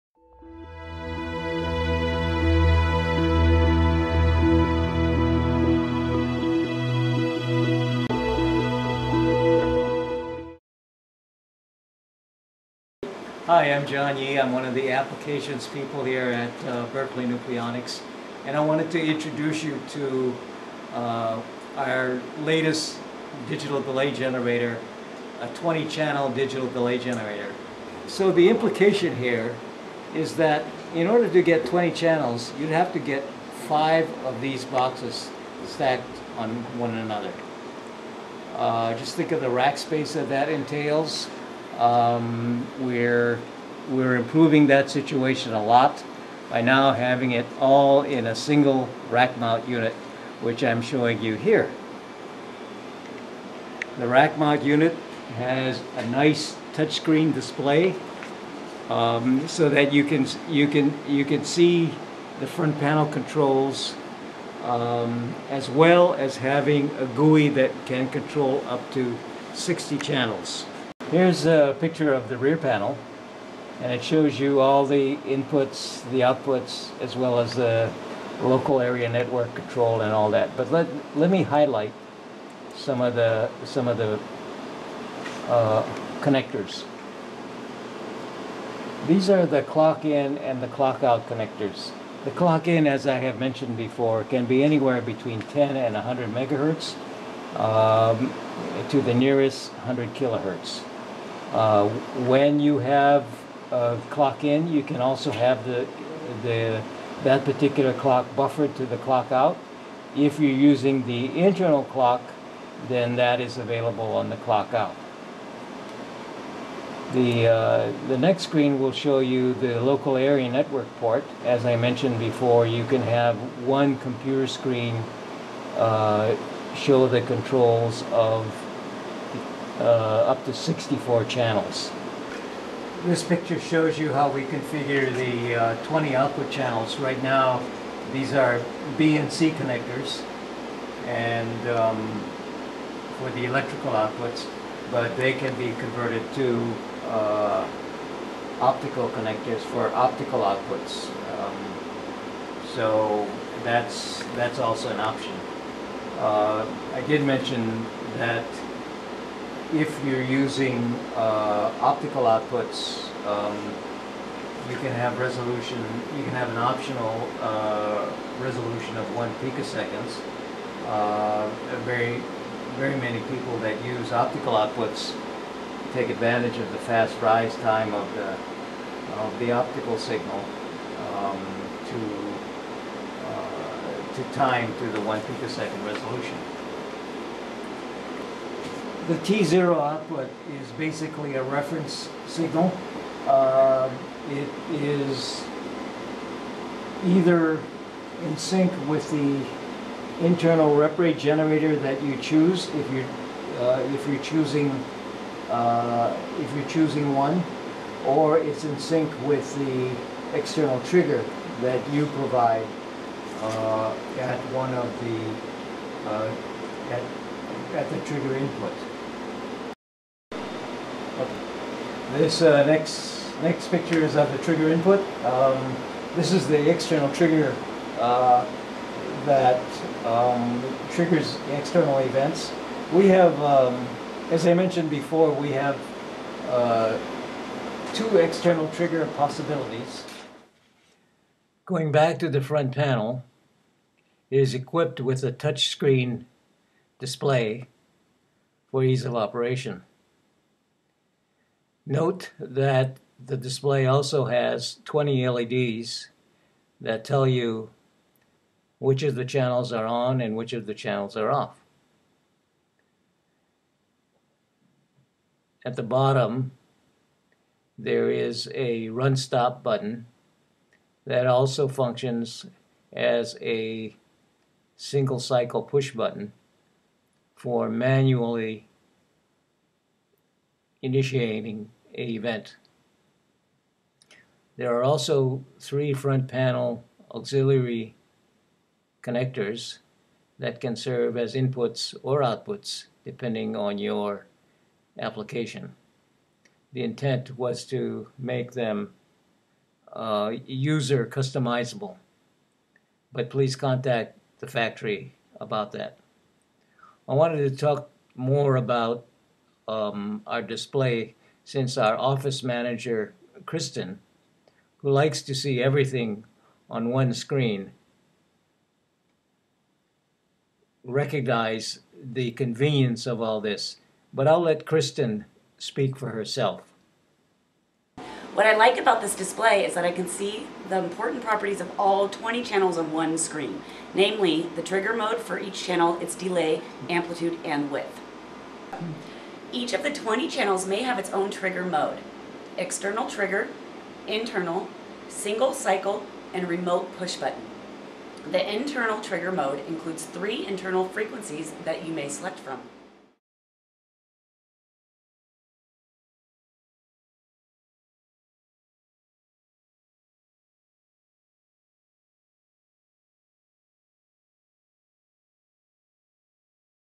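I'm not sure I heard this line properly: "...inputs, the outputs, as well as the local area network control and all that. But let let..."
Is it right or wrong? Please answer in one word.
right.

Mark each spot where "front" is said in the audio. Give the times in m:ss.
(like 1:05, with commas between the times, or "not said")
1:02, 4:02, 4:45.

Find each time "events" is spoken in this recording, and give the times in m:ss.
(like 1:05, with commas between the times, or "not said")
3:51, 4:42.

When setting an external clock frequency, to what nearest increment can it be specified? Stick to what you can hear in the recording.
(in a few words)
100 kHz.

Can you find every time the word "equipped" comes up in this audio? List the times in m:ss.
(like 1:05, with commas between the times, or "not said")
4:04.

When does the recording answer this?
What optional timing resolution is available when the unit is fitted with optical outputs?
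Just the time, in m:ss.
2:49.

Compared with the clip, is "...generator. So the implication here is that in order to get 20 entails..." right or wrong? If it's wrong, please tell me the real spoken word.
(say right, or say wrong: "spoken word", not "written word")
wrong: "channels", not "entails".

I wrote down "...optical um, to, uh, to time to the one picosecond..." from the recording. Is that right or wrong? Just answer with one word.
wrong.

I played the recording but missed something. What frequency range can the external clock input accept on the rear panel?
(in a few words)
10 to 100 MHz.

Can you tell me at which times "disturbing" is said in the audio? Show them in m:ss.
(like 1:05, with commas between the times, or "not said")
not said.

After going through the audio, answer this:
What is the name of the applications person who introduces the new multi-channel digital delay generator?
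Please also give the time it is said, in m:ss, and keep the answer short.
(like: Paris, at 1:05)
John Yee, at 0:13.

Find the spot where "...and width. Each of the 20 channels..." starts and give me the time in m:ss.
5:37.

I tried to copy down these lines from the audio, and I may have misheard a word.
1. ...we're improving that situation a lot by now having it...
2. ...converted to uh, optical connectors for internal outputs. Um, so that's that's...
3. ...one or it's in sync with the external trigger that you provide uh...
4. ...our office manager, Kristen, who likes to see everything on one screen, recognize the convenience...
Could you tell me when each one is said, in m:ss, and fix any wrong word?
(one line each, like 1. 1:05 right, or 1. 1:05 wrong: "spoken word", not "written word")
1. 0:43 right
2. 2:25 wrong: "optical", not "internal"
3. 3:27 right
4. 5:11 right.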